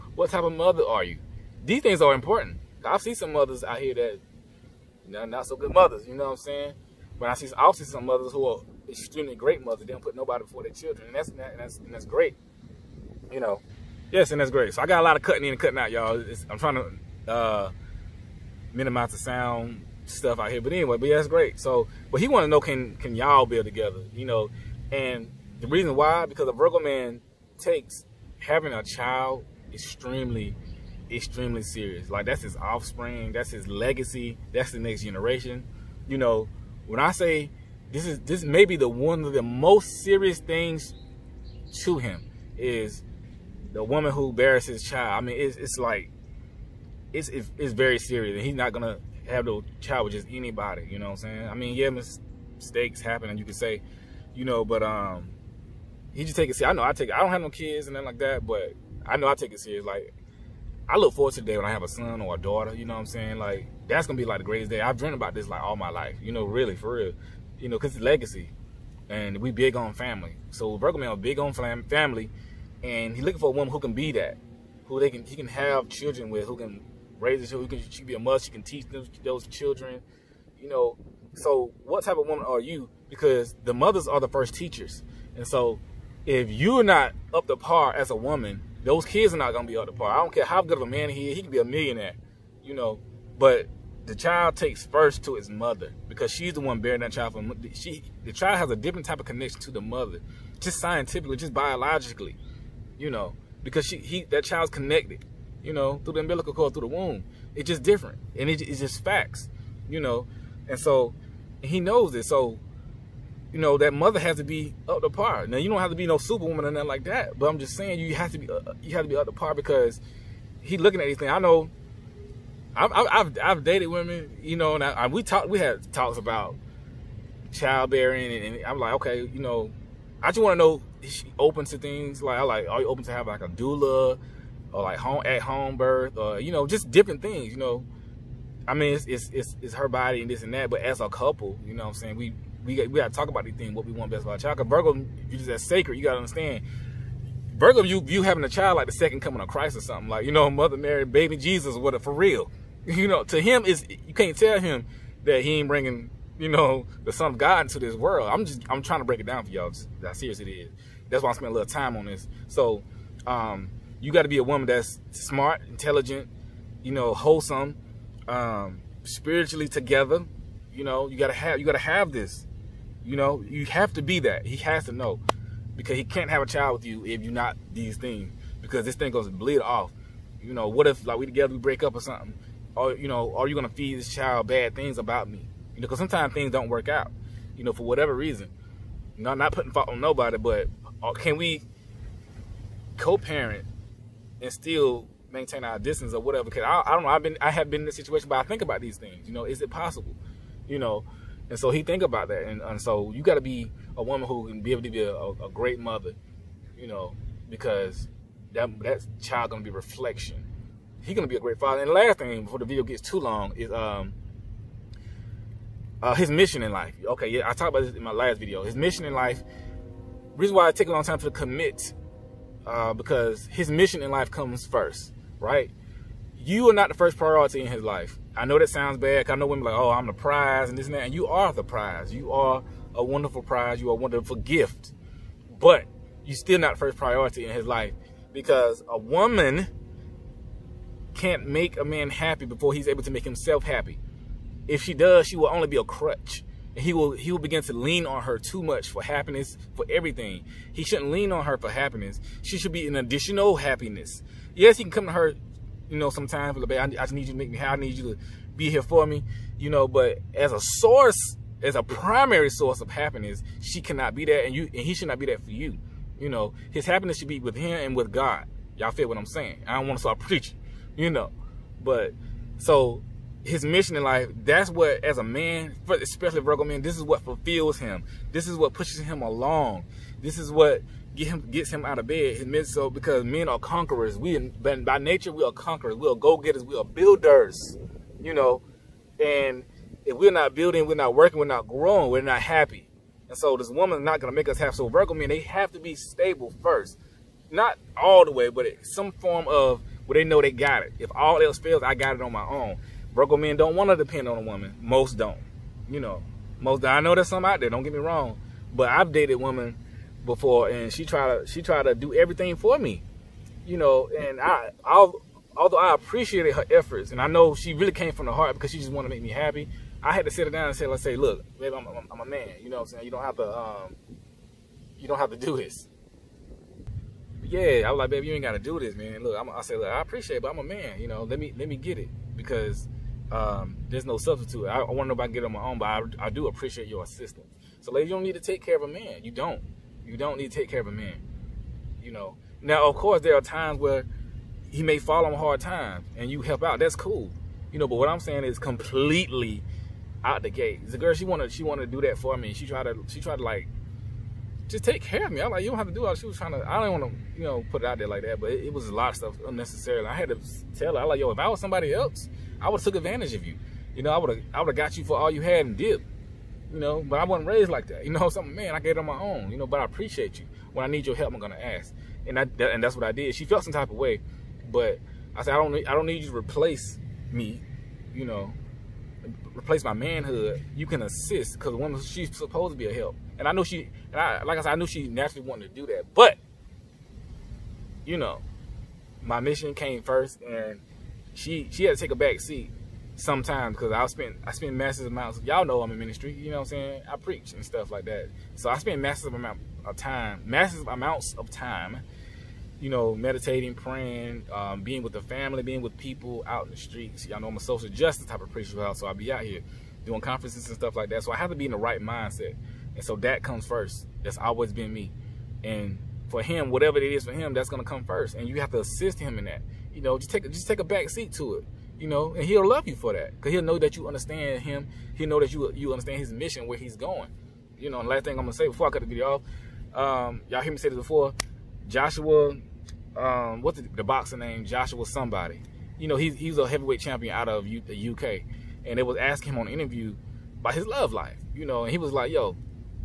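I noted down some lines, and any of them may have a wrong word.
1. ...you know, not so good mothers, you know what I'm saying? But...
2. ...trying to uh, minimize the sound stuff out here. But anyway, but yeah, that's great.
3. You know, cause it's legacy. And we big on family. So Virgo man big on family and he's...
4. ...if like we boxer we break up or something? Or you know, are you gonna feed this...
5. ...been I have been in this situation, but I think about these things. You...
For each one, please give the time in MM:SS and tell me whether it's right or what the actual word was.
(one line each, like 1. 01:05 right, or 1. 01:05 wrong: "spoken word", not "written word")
1. 00:05 right
2. 00:16 right
3. 01:07 right
4. 03:00 wrong: "together", not "boxer"
5. 03:17 right.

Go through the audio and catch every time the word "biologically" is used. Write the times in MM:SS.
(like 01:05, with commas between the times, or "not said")
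01:41.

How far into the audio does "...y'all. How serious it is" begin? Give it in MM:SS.
02:39.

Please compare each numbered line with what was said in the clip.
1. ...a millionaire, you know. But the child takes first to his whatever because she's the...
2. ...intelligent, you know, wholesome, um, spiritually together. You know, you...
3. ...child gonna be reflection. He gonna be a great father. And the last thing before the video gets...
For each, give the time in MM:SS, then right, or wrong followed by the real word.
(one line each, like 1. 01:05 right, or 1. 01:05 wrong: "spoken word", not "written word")
1. 01:31 wrong: "mother", not "whatever"
2. 02:45 right
3. 03:29 right.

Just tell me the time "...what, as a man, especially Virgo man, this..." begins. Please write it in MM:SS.
04:34.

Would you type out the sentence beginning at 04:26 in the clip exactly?
You know, his happiness should be with him and with God.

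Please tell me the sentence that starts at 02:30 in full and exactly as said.
Like, you know, Mother Mary, baby Jesus, what a, for real.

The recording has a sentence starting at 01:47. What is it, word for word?
It's just different, and it, it's just facts, you know, and so and he knows it.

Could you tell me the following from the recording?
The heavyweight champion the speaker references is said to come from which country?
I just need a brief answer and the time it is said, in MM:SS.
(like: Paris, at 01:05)
UK, at 07:18.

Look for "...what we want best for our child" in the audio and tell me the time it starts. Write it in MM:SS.
02:23.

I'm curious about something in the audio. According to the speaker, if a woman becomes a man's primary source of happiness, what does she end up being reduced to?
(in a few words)
a crutch.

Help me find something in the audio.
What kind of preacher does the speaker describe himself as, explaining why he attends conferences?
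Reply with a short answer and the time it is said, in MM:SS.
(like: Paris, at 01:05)
social justice, at 06:47.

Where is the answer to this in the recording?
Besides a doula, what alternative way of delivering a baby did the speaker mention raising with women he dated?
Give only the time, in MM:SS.
02:15.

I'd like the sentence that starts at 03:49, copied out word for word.
I know women like, oh, I'm the prize and this and that.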